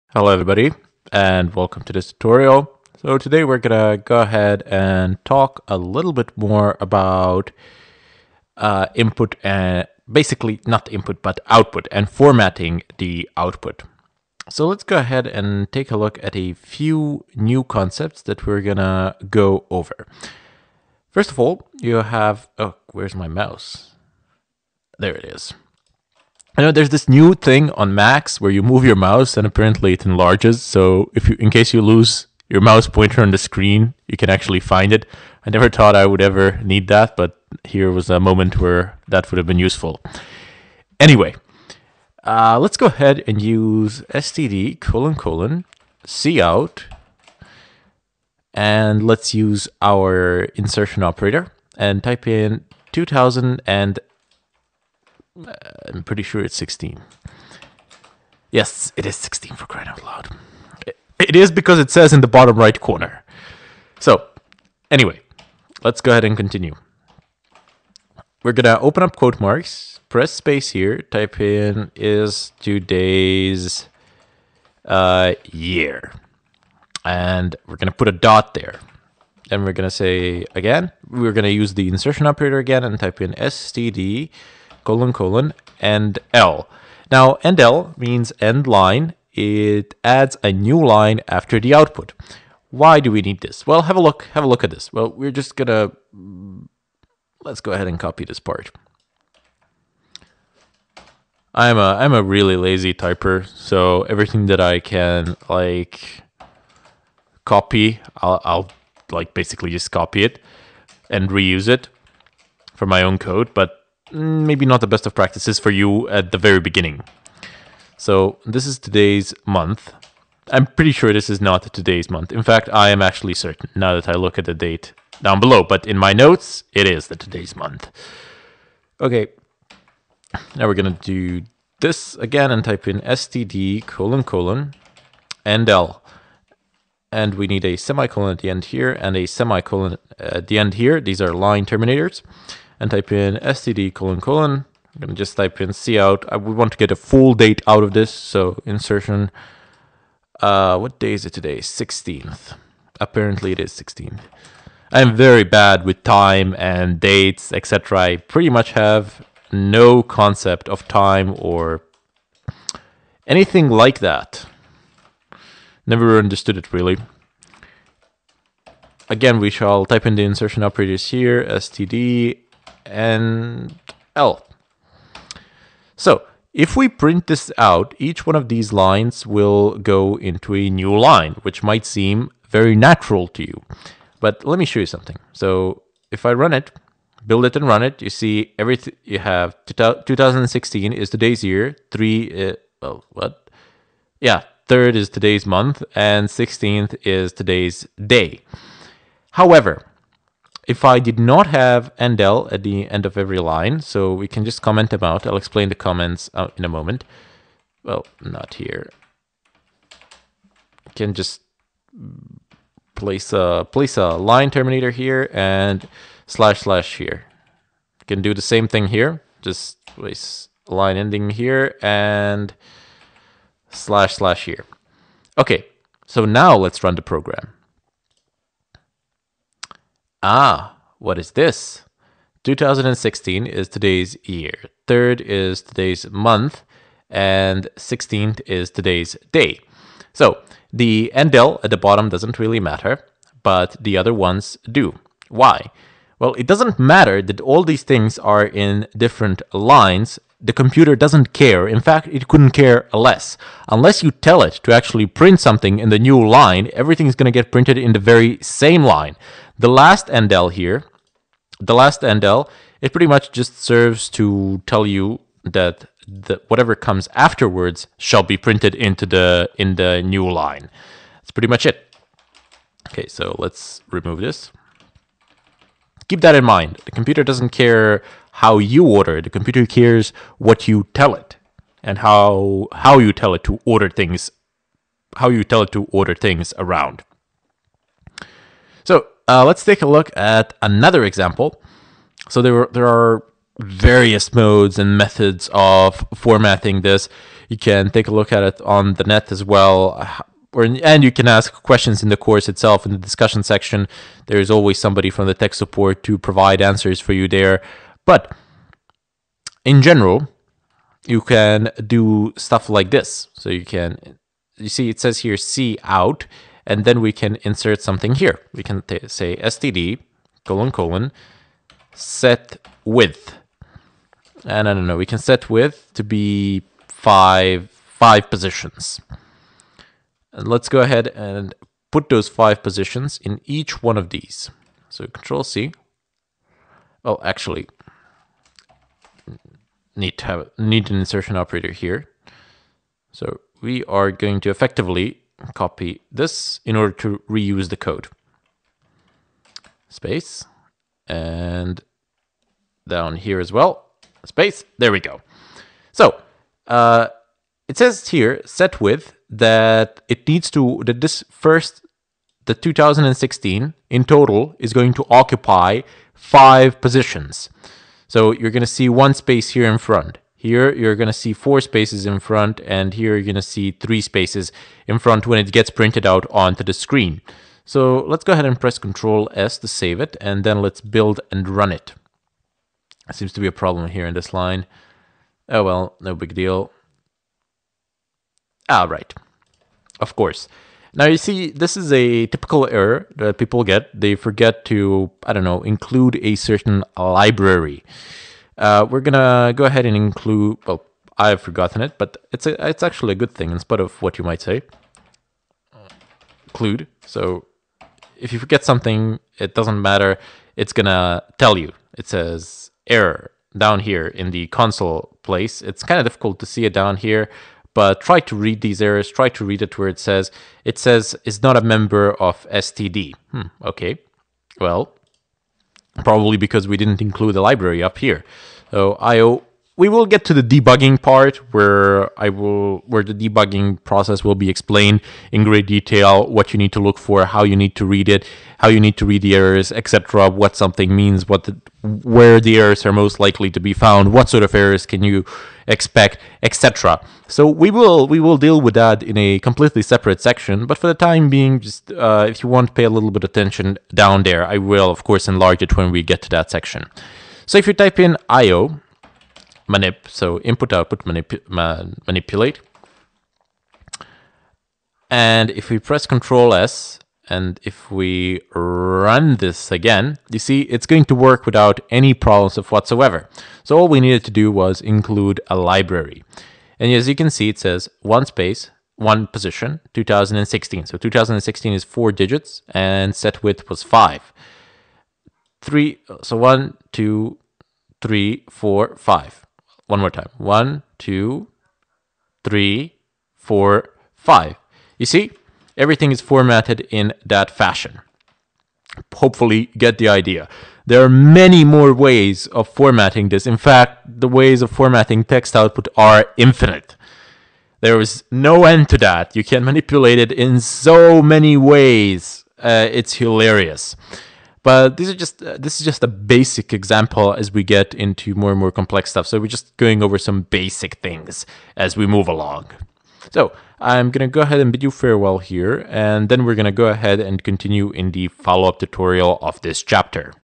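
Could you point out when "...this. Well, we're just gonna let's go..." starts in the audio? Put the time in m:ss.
1:34.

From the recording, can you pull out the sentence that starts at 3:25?
I'll explain the comments uh, in a moment.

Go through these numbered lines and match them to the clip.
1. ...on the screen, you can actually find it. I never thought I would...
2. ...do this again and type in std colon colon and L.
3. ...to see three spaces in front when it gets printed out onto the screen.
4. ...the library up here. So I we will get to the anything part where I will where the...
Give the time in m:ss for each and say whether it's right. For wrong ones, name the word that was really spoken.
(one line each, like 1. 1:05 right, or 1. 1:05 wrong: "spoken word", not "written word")
1. 0:33 right
2. 2:11 right
3. 6:13 right
4. 7:07 wrong: "debugging", not "anything".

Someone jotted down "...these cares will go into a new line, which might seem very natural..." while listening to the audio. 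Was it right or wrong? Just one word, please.
wrong.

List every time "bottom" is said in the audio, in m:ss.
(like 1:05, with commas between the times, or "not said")
1:02, 4:01.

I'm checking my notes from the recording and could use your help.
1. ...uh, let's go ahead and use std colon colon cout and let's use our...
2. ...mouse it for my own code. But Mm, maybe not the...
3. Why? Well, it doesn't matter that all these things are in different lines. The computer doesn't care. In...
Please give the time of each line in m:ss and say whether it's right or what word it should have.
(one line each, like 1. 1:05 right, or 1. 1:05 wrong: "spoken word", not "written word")
1. 0:42 right
2. 1:51 wrong: "reuse", not "mouse"
3. 4:05 right.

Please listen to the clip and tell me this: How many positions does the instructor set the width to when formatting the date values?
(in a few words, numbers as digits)
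5.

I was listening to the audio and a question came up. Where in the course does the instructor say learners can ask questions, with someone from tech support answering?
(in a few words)
discussion section.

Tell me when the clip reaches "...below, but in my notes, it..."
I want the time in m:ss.
2:05.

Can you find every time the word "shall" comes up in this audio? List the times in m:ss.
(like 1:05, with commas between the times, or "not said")
2:49, 4:27.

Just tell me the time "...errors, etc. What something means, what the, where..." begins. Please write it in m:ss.
7:19.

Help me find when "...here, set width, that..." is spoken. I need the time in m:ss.
5:58.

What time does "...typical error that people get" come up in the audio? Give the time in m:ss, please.
6:32.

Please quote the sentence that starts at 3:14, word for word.
Yeah, 3rd is today's month and 16th is today's day.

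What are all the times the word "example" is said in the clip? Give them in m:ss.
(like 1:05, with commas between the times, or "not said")
4:51, 8:36.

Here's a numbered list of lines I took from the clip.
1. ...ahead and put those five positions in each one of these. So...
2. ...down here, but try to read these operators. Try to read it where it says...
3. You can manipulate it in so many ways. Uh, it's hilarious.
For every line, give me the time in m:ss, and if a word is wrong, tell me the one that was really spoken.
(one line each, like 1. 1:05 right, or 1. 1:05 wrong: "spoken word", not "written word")
1. 5:30 right
2. 6:56 wrong: "errors", not "operators"
3. 8:29 right.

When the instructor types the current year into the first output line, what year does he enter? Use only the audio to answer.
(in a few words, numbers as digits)
2016.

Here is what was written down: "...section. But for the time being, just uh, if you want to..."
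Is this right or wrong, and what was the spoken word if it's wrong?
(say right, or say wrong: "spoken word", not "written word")
right.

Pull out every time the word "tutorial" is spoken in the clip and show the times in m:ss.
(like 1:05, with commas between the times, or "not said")
0:02, 8:48.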